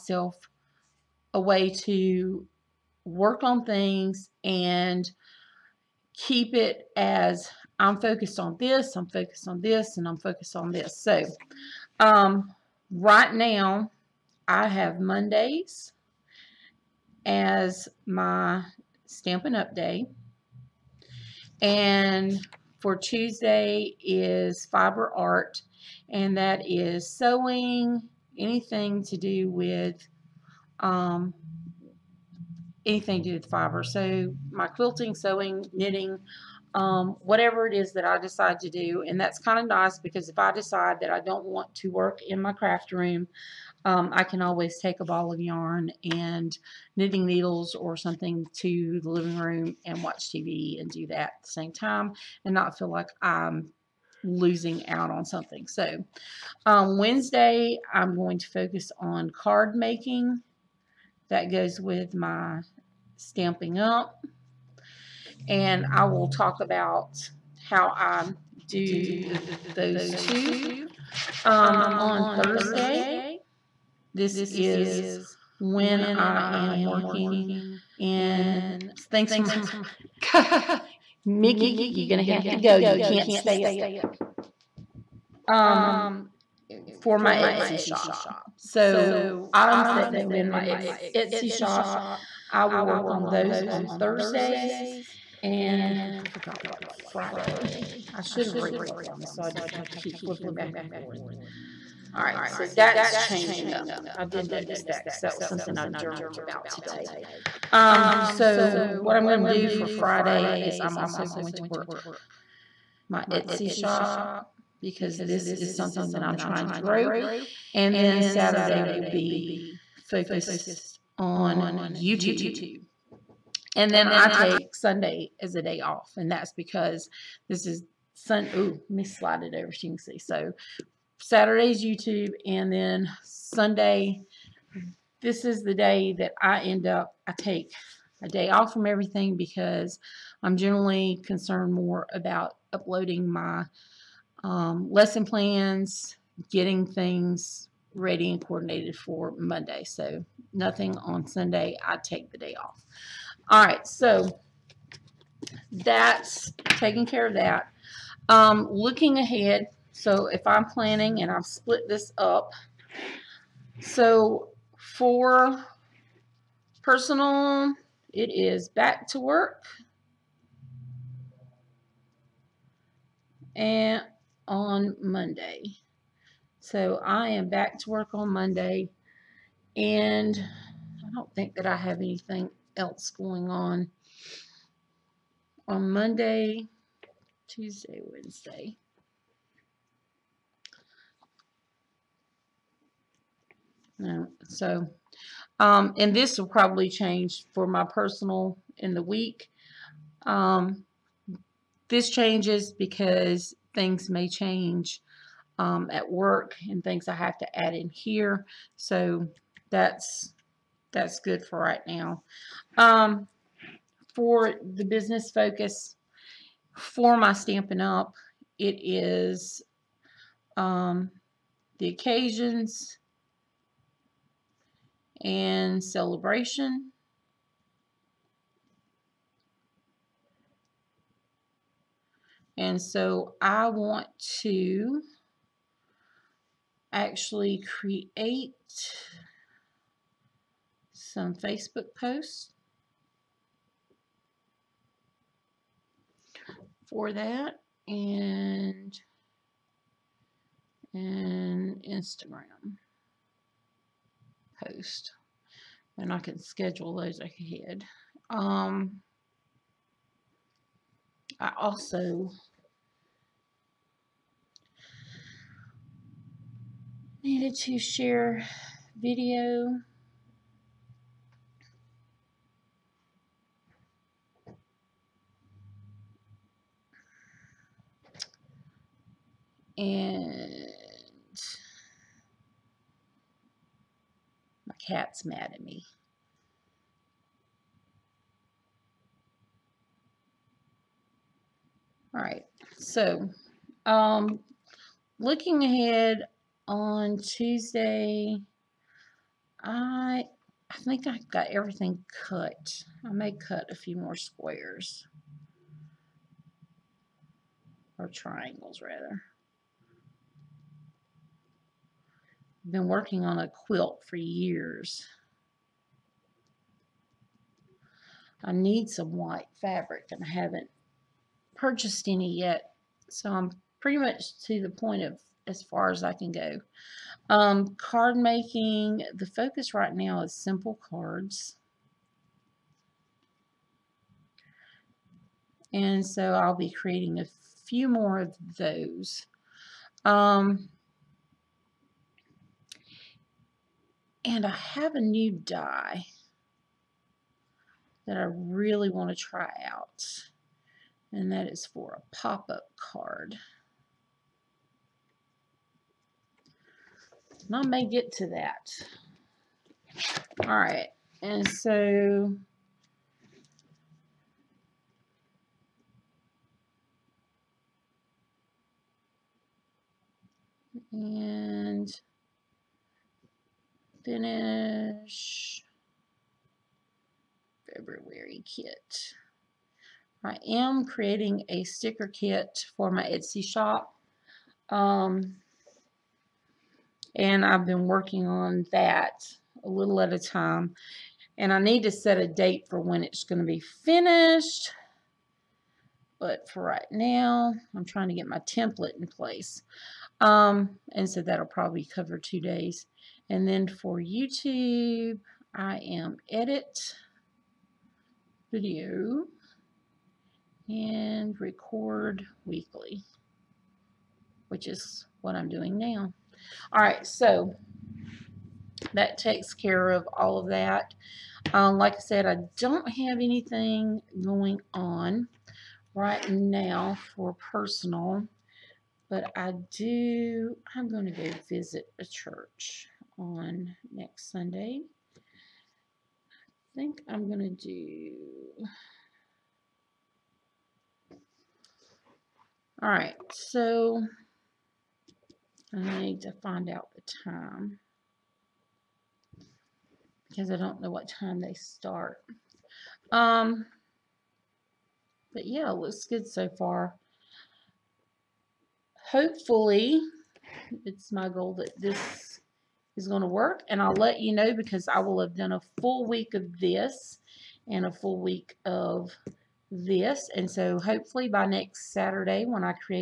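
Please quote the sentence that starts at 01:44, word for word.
I did notice that because that was something I journaled about today.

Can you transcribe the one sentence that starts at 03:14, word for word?
so, um, and this will probably change for my personal in the week.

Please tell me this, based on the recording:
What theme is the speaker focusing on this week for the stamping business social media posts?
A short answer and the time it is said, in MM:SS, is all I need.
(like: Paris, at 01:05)
occasions and celebration, at 03:41.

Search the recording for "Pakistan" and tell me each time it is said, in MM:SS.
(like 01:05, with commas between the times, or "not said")
not said.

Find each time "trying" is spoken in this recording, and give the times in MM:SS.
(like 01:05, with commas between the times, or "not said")
01:56, 06:37.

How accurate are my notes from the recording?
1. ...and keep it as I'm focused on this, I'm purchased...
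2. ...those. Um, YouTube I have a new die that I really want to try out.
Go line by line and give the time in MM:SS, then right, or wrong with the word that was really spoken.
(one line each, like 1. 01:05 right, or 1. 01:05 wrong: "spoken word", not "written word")
1. 00:04 wrong: "focused", not "purchased"
2. 05:38 wrong: "And", not "YouTube".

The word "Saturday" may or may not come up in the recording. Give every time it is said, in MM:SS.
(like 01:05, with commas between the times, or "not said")
01:58, 02:11, 07:51.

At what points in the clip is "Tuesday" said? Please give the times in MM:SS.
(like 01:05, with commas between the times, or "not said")
00:22, 03:07, 04:57.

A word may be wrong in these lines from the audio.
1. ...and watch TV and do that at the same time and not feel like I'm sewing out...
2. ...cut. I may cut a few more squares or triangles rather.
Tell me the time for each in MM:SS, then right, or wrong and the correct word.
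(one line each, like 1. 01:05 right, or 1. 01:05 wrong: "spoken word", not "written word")
1. 00:49 wrong: "losing", not "sewing"
2. 05:02 right.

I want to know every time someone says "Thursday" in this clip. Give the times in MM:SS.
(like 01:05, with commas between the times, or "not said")
01:12, 01:33.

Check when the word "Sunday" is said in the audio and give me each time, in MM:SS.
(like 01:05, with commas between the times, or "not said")
02:04, 02:13, 02:31, 07:14.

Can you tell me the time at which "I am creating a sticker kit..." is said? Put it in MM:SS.
06:20.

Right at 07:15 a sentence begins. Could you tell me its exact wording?
I think I'm going to do...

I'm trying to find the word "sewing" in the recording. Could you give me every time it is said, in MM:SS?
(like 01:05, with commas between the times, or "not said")
00:27, 00:35.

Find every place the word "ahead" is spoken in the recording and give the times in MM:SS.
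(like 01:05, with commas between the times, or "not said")
02:39, 04:17, 04:55.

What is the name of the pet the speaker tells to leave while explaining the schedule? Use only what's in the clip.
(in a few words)
Mickey.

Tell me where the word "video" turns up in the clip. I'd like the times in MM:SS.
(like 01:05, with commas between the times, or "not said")
04:28, 06:48.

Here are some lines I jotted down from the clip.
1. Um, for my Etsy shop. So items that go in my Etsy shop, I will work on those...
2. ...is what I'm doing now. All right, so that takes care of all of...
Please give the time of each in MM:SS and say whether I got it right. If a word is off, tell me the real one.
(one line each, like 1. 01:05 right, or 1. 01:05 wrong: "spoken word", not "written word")
1. 01:25 right
2. 06:54 right.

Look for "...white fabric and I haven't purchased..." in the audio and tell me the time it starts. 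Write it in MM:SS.
05:19.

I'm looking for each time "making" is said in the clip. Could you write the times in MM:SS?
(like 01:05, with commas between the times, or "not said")
00:59, 05:28.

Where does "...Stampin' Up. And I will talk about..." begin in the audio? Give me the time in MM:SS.
01:03.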